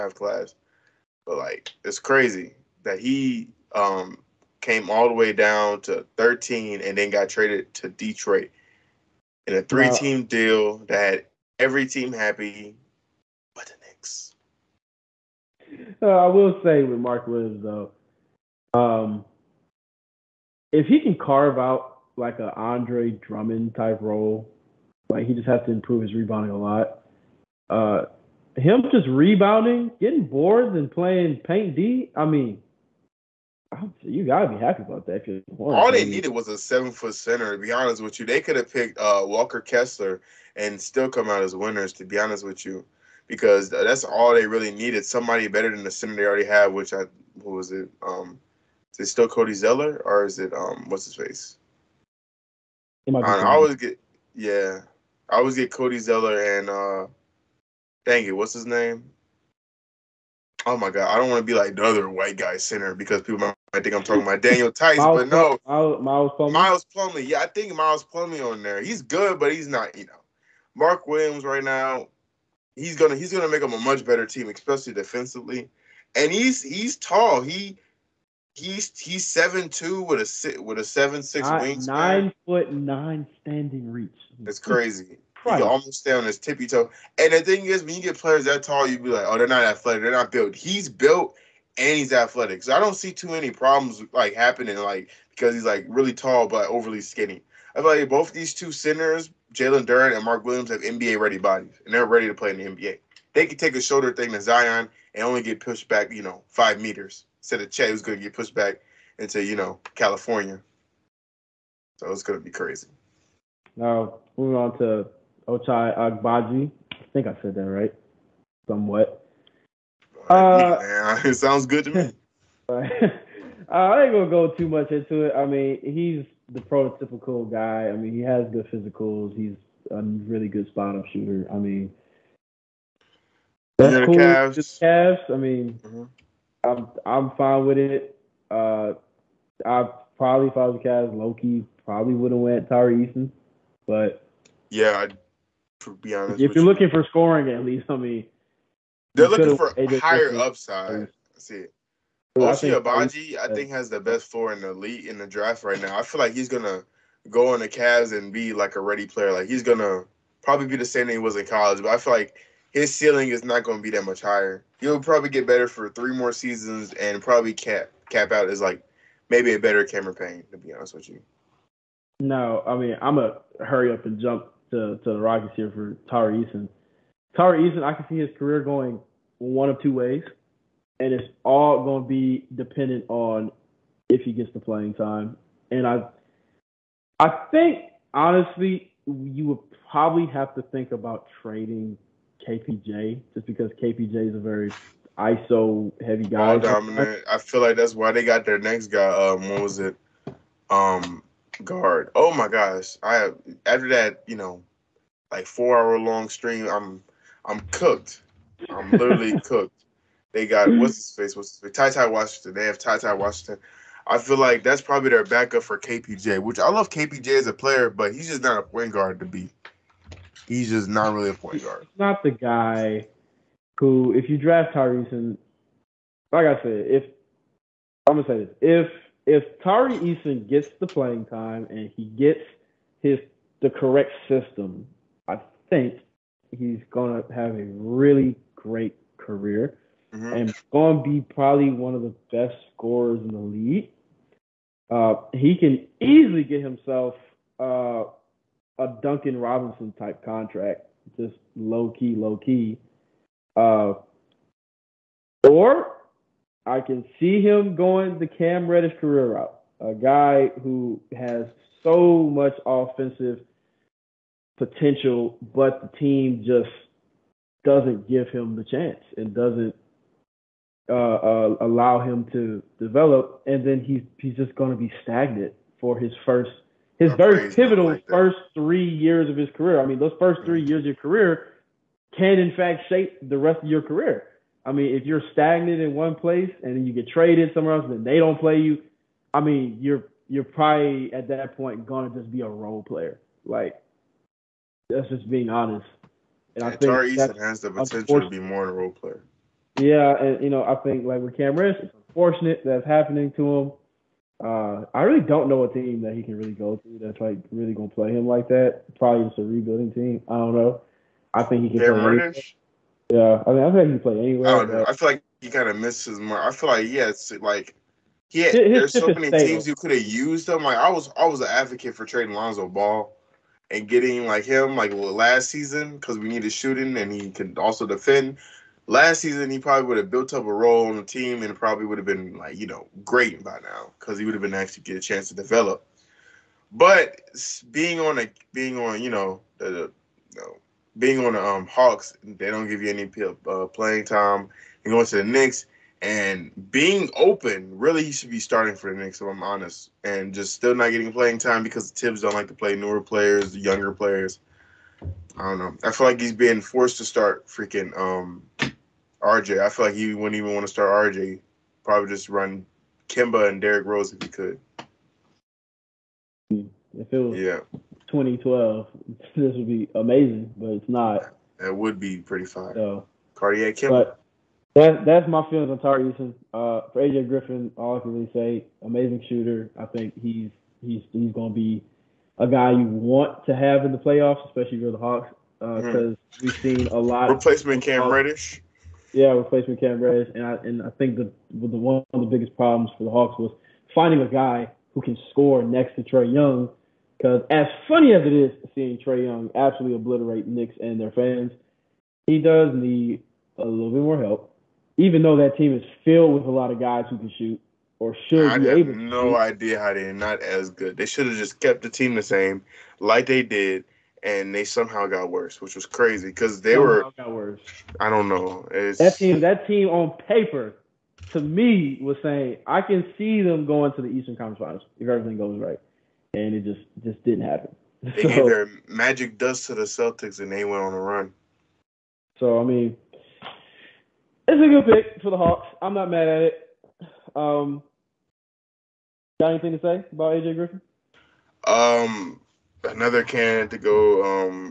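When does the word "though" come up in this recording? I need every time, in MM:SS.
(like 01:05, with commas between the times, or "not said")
00:17, 06:45.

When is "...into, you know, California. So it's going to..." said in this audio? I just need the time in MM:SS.
01:49.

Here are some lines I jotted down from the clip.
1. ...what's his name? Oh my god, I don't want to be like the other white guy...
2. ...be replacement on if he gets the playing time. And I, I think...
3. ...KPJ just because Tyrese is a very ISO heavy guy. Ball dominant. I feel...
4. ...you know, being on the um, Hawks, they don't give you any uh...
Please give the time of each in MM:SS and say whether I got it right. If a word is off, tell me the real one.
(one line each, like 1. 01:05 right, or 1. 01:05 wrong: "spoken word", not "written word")
1. 00:58 right
2. 03:02 wrong: "dependent", not "replacement"
3. 03:12 wrong: "KPJ", not "Tyrese"
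4. 05:40 right.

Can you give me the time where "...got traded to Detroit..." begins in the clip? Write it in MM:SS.
00:07.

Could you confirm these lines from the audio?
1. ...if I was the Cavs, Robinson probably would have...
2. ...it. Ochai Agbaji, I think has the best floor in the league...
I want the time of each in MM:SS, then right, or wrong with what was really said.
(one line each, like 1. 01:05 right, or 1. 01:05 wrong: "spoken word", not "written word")
1. 02:20 wrong: "Loki", not "Robinson"
2. 02:31 right.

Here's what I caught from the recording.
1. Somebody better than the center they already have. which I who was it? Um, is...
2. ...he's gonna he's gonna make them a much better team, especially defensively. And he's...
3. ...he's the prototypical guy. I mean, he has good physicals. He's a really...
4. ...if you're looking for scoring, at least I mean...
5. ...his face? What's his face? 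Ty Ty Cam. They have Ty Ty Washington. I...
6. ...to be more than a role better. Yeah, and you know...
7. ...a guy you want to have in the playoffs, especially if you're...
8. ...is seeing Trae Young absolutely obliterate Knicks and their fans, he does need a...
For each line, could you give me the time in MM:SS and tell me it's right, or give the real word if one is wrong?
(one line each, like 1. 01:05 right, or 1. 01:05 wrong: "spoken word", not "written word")
1. 00:45 right
2. 01:12 right
3. 02:05 right
4. 02:26 right
5. 03:30 wrong: "Washington", not "Cam"
6. 04:58 wrong: "player", not "better"
7. 06:22 right
8. 06:38 right.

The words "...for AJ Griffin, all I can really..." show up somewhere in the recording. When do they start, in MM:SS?
06:16.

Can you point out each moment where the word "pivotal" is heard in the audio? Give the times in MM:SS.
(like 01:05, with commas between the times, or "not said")
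04:37.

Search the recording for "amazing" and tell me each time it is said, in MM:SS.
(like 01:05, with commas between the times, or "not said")
06:09, 06:18.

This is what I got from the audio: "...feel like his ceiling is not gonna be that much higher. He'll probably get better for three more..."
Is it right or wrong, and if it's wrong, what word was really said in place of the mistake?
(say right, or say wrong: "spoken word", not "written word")
right.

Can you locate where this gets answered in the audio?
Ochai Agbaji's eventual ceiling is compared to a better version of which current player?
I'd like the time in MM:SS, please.
02:49.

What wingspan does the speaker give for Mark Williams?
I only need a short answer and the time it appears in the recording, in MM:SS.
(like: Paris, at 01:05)
7'6", at 01:20.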